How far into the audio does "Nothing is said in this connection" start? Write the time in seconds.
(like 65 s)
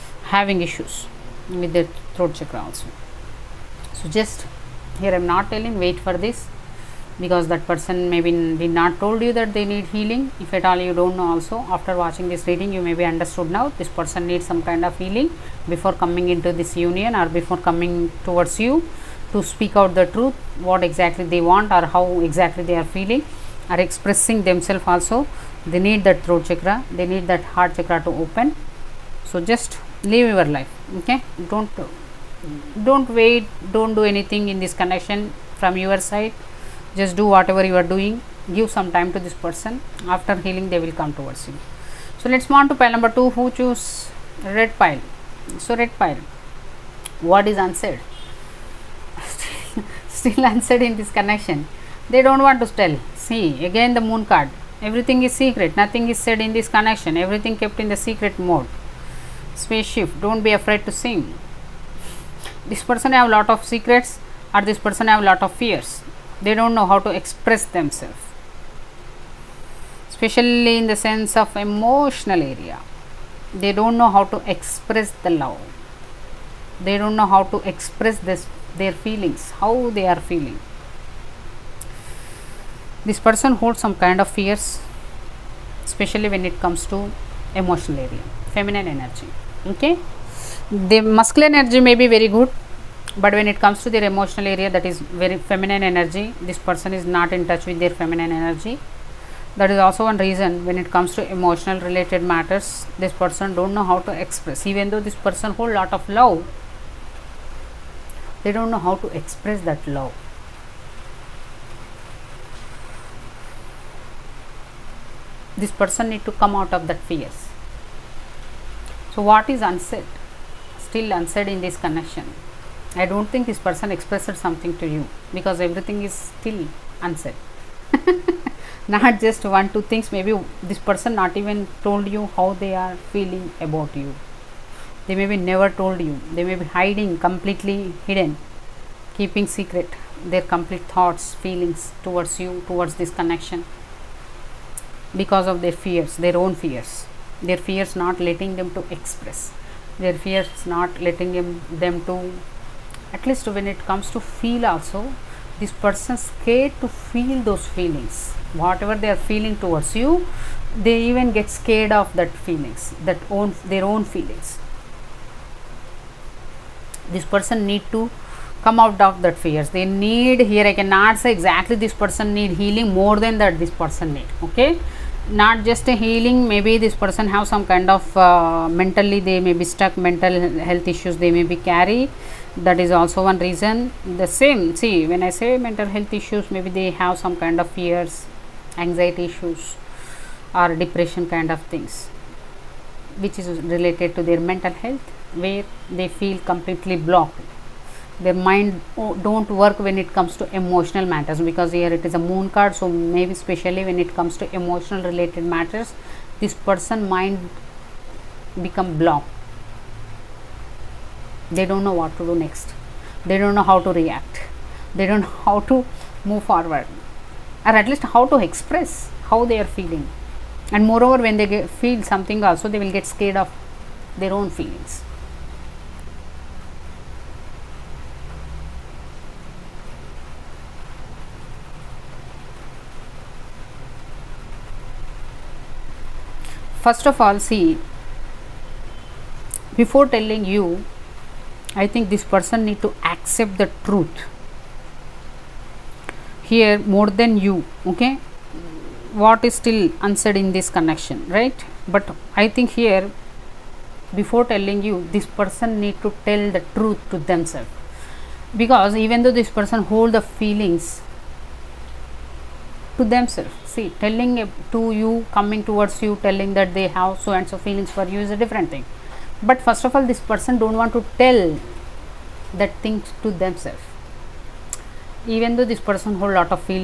55 s.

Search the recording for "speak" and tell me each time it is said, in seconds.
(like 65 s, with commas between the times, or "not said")
19 s.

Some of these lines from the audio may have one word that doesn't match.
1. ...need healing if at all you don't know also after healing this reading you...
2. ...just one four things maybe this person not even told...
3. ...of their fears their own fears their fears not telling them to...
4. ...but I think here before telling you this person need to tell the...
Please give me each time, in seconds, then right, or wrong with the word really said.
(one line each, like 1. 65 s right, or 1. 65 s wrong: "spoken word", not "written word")
1. 9 s wrong: "watching", not "healing"
2. 129 s wrong: "two", not "four"
3. 145 s wrong: "letting", not "telling"
4. 251 s right.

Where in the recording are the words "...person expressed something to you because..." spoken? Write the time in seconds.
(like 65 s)
123 s.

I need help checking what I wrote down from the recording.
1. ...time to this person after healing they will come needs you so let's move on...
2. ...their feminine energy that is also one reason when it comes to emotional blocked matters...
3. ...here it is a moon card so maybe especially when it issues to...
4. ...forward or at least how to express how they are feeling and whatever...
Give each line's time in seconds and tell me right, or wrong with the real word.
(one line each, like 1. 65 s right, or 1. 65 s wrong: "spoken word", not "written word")
1. 38 s wrong: "towards", not "needs"
2. 97 s wrong: "related", not "blocked"
3. 201 s wrong: "comes", not "issues"
4. 216 s wrong: "moreover", not "whatever".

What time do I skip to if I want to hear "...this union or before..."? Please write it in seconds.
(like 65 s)
16 s.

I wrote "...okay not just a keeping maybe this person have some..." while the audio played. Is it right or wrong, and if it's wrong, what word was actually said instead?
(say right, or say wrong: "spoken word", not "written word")
wrong: "healing", not "keeping".